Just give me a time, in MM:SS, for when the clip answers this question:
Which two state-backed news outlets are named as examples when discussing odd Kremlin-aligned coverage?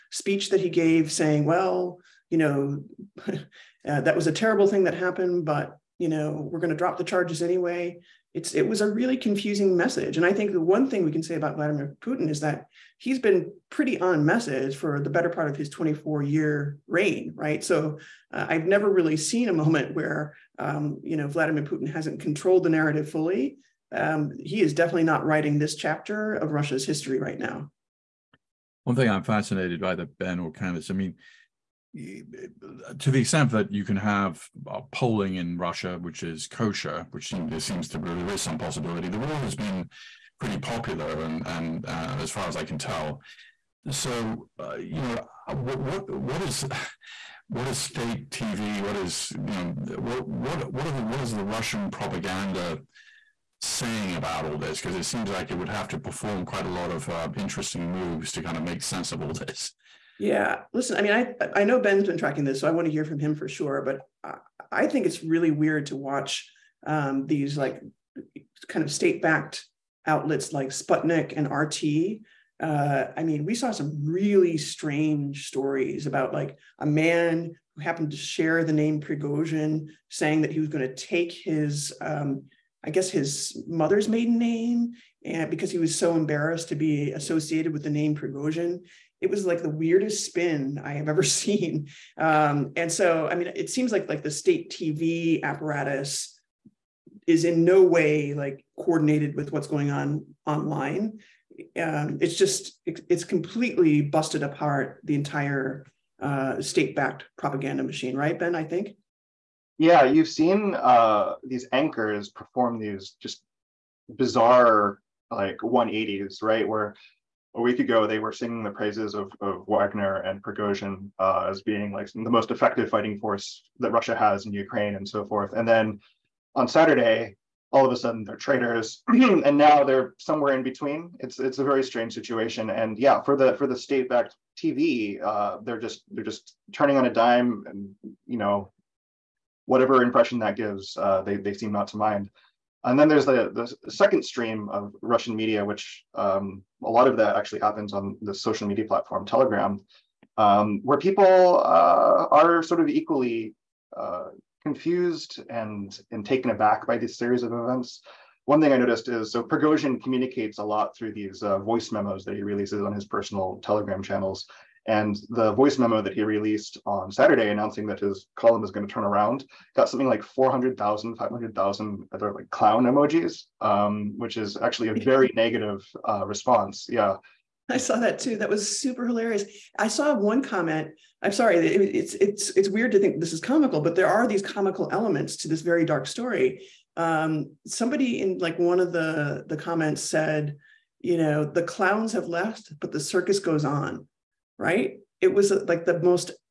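01:10.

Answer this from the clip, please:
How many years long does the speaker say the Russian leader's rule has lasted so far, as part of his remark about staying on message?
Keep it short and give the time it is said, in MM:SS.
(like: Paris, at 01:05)
24, at 00:15.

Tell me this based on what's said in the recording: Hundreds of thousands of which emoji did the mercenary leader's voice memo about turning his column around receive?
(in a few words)
Clown emojis.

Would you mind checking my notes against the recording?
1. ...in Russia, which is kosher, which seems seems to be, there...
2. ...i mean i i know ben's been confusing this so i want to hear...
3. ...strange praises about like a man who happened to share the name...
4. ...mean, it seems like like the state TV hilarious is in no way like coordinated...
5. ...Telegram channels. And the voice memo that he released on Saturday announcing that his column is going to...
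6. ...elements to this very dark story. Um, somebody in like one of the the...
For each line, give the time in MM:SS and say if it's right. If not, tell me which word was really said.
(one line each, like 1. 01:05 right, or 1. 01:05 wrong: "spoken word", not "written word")
1. 00:35 right
2. 01:00 wrong: "tracking", not "confusing"
3. 01:14 wrong: "stories", not "praises"
4. 01:33 wrong: "apparatus", not "hilarious"
5. 02:43 right
6. 03:04 right.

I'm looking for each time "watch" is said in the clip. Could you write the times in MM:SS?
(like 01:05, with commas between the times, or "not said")
01:05.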